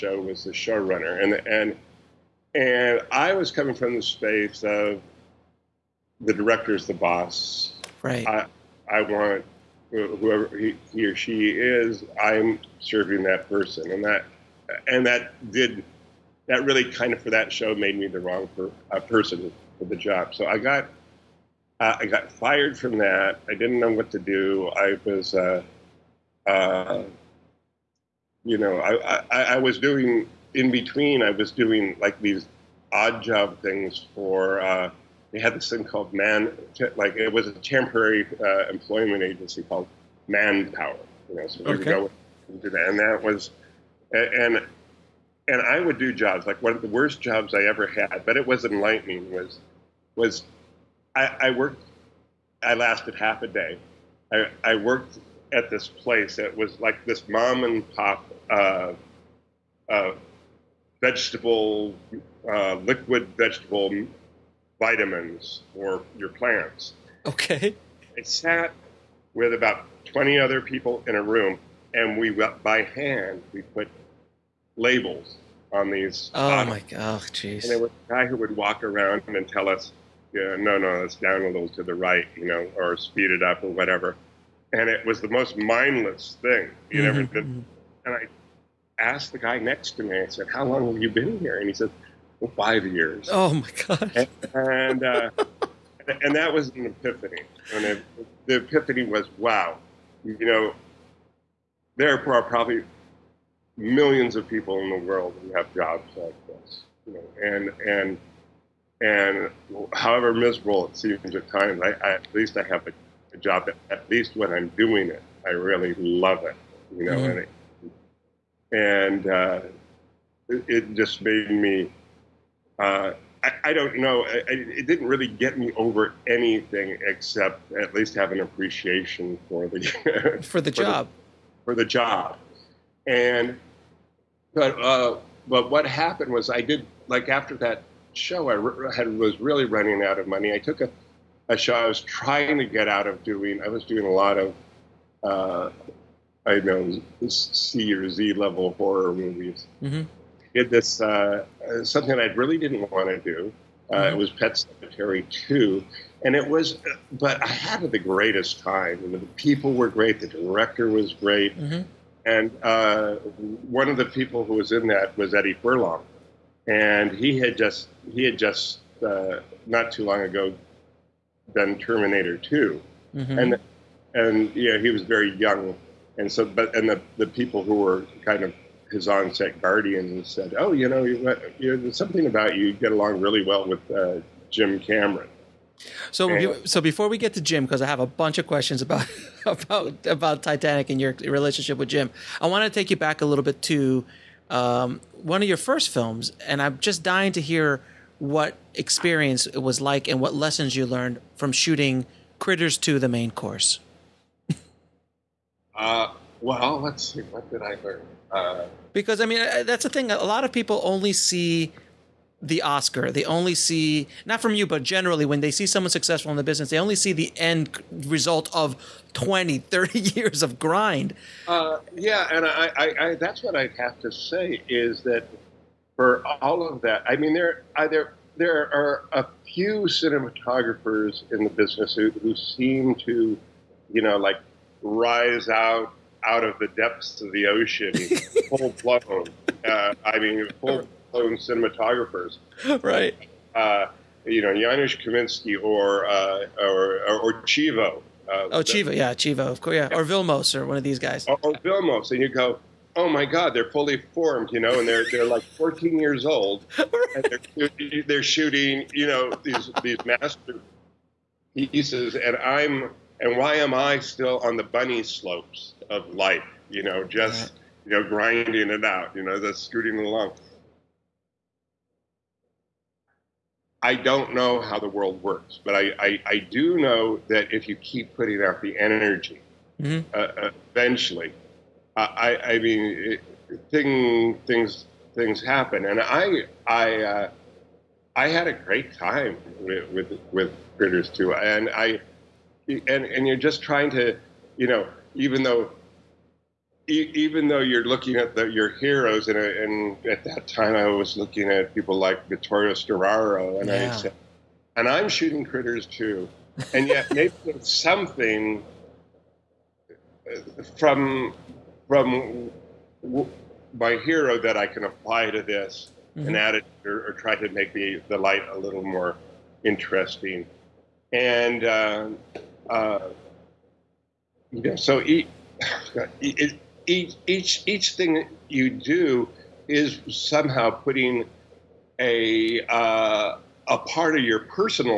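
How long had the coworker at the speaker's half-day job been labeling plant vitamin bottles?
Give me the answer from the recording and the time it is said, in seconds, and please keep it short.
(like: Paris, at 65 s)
5 years, at 92 s.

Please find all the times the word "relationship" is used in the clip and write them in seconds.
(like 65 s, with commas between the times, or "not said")
191 s.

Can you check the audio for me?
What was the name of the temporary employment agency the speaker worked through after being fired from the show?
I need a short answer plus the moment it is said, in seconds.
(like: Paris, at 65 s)
Manpower, at 40 s.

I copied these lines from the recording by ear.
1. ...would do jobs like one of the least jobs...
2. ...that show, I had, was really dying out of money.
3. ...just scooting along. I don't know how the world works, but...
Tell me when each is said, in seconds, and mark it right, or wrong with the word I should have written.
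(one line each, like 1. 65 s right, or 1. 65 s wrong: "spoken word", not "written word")
1. 45 s wrong: "worst", not "least"
2. 137 s wrong: "running", not "dying"
3. 269 s right.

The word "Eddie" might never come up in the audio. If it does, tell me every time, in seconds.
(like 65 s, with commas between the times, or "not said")
165 s.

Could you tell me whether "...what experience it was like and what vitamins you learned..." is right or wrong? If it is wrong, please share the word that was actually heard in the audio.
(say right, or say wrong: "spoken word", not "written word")
wrong: "lessons", not "vitamins".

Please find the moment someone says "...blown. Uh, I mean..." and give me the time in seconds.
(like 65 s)
238 s.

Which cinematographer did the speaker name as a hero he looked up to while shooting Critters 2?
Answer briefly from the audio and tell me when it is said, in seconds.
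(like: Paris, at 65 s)
Vittorio Storaro, at 302 s.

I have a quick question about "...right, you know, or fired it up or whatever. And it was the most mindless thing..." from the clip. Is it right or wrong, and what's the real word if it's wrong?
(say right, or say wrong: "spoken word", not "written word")
wrong: "speed", not "fired".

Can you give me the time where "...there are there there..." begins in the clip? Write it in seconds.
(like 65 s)
227 s.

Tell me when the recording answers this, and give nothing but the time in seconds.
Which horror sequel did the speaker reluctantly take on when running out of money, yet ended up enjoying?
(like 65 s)
154 s.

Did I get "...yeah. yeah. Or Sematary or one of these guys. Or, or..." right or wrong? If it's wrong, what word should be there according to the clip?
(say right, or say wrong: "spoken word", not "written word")
wrong: "Vilmos", not "Sematary".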